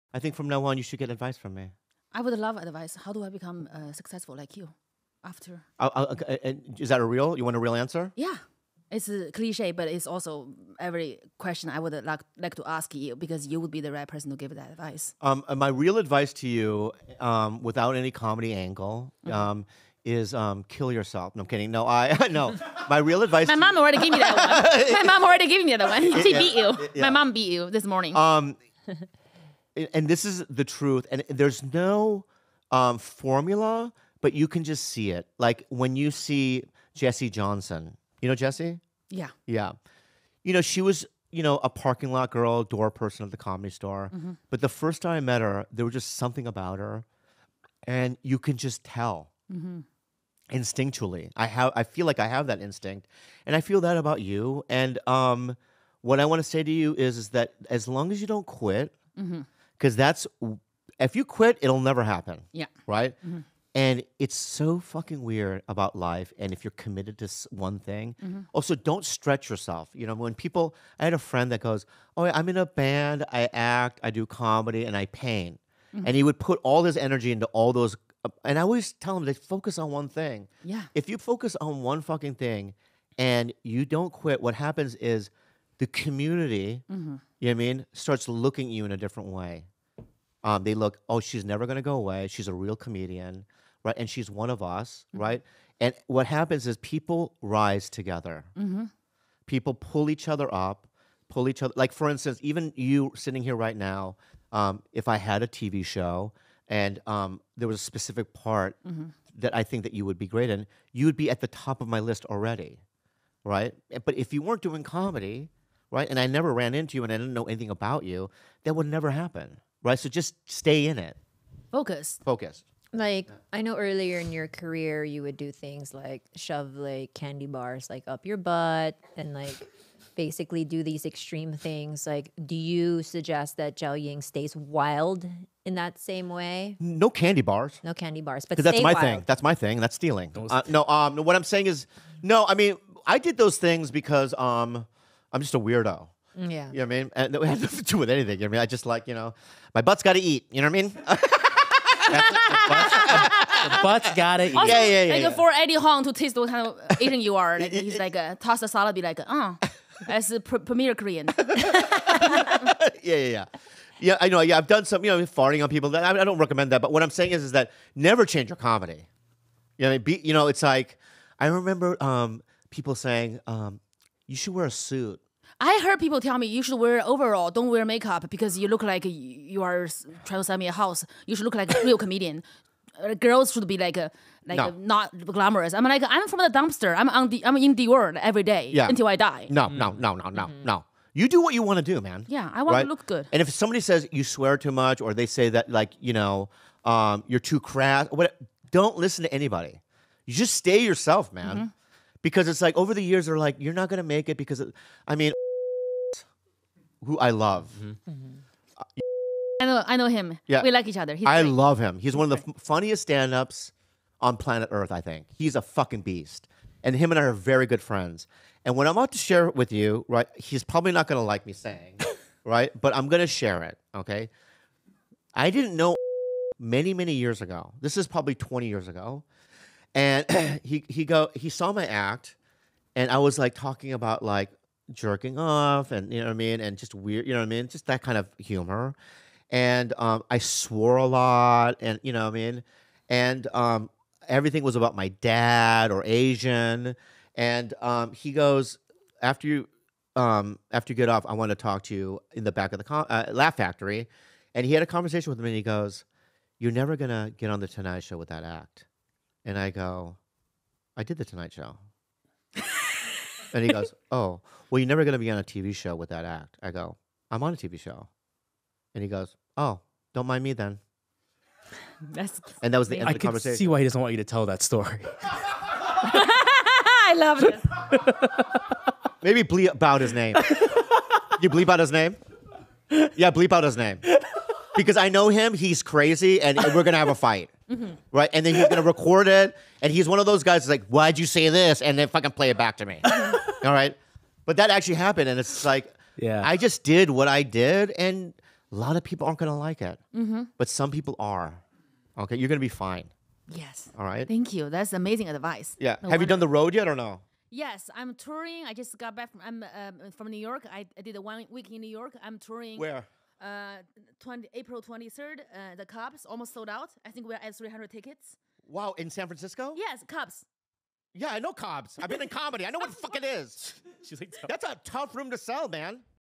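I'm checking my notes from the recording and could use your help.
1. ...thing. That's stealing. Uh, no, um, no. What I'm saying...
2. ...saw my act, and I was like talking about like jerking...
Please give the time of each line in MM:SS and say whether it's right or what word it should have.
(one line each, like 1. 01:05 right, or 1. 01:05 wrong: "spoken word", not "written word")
1. 02:19 right
2. 03:51 right.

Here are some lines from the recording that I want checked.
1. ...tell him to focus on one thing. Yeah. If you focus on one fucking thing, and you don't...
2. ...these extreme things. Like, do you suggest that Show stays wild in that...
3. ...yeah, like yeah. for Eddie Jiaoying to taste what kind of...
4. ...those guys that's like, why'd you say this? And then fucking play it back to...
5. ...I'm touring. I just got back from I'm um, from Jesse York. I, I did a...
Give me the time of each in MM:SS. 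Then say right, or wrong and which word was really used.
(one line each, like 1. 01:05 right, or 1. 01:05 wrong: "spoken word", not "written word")
1. 01:18 right
2. 02:10 wrong: "Jiaoying", not "Show"
3. 02:35 wrong: "Huang", not "Jiaoying"
4. 04:50 right
5. 05:07 wrong: "New", not "Jesse".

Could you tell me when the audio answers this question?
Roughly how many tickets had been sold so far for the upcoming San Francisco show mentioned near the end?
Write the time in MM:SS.
05:17.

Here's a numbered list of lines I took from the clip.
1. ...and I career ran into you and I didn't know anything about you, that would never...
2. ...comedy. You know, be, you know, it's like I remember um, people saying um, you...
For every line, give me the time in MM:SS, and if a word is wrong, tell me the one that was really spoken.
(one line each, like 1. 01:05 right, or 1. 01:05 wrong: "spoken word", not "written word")
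1. 01:56 wrong: "never", not "career"
2. 02:48 right.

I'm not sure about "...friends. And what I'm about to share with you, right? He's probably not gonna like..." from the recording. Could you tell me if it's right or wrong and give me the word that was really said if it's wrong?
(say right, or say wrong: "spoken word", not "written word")
right.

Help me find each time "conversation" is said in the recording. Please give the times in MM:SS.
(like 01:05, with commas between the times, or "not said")
04:14, 04:33.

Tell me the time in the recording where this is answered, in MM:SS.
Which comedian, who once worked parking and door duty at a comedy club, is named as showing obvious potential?
00:36.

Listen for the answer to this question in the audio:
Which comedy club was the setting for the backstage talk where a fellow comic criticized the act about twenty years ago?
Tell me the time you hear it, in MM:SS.
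04:13.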